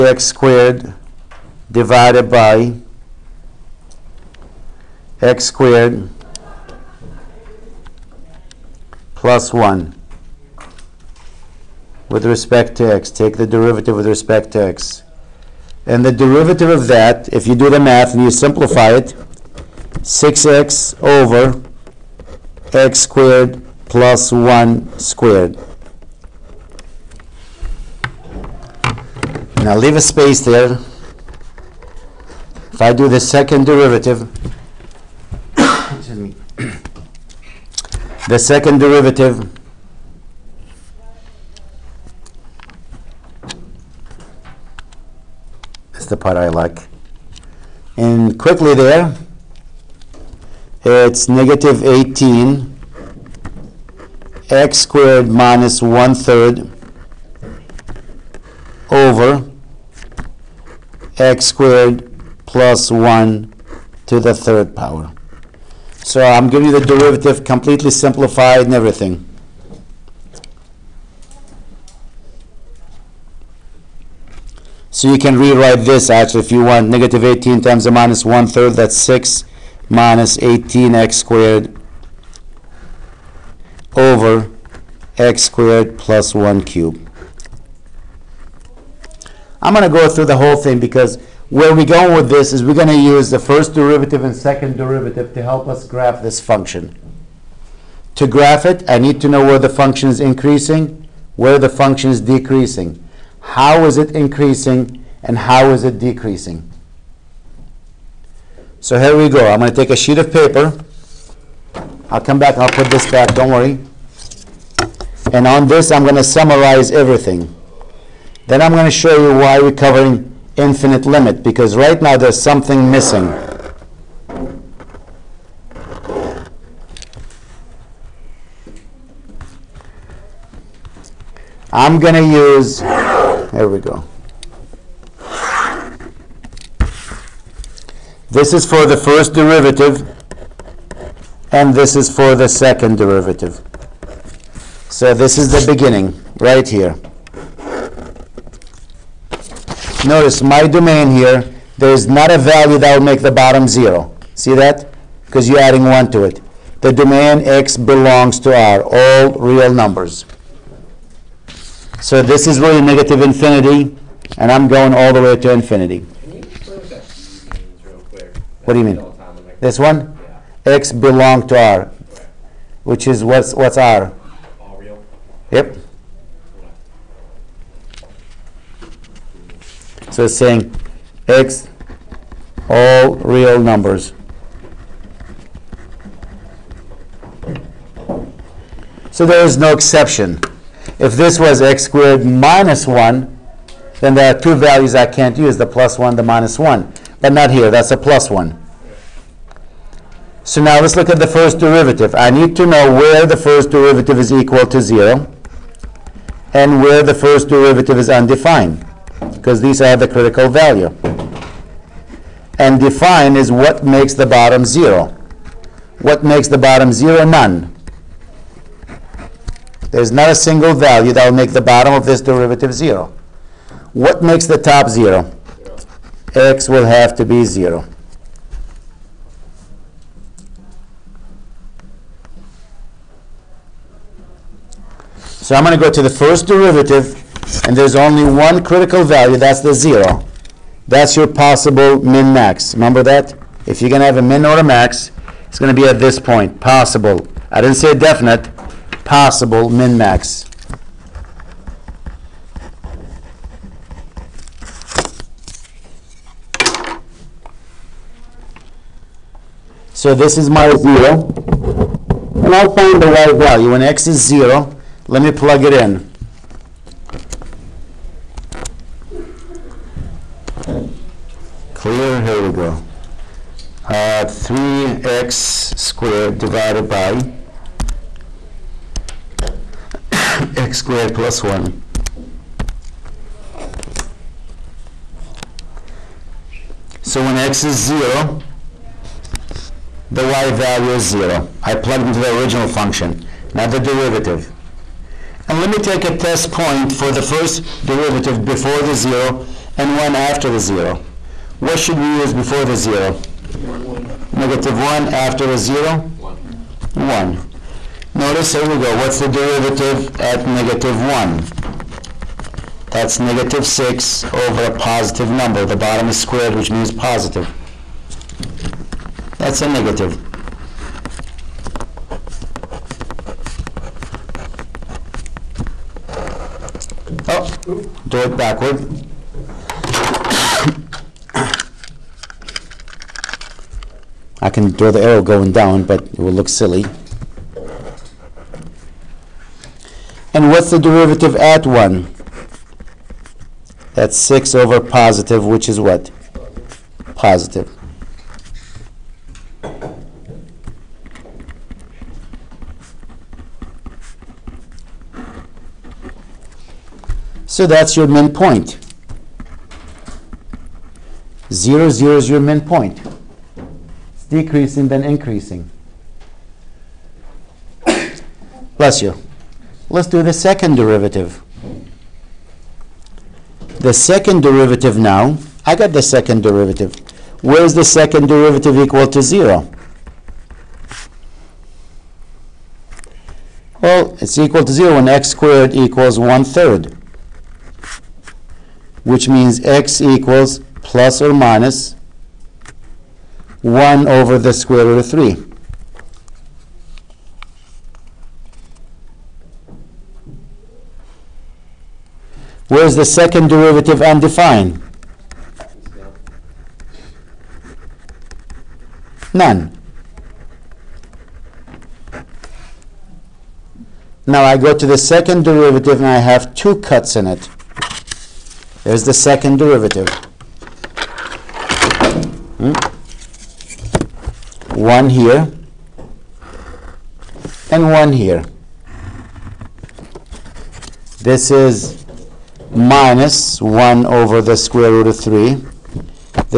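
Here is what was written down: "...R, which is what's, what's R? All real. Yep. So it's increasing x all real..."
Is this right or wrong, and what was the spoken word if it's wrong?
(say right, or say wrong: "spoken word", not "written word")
wrong: "saying", not "increasing".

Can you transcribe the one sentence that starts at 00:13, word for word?
Take the derivative with respect to x.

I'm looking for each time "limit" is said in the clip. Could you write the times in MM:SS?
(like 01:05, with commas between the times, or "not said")
02:01.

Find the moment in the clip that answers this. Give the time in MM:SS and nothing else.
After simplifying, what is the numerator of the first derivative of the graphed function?
00:20.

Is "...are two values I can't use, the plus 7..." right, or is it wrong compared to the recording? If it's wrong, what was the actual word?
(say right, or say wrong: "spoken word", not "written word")
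wrong: "1", not "7".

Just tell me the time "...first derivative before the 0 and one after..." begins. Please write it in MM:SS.
04:57.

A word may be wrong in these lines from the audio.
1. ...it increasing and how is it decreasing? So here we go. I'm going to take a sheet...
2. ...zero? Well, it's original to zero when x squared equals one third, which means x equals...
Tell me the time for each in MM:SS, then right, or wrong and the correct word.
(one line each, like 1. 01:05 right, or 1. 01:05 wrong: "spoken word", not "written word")
1. 01:43 right
2. 06:19 wrong: "equal", not "original".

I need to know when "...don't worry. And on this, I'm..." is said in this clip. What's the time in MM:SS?
01:53.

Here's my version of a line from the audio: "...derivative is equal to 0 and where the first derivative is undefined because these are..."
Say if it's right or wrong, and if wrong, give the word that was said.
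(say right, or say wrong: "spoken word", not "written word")
right.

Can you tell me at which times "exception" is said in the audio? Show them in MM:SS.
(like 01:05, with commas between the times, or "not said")
03:09.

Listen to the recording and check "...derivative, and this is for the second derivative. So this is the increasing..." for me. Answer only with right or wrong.
wrong.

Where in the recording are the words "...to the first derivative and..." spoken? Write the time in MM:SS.
03:55.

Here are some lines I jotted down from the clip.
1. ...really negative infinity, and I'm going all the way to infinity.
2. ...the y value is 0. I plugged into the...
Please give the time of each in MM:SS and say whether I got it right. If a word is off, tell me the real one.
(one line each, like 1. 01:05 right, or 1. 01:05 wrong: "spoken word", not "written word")
1. 02:42 right
2. 04:50 right.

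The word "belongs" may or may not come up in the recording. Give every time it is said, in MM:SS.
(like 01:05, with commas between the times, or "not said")
02:37, 02:50.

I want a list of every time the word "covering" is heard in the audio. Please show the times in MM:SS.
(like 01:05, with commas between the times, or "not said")
01:59.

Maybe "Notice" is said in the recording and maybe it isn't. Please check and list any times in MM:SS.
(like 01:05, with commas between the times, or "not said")
02:30, 05:08.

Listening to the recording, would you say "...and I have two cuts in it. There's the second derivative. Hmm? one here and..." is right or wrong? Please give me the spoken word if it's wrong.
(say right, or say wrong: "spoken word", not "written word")
right.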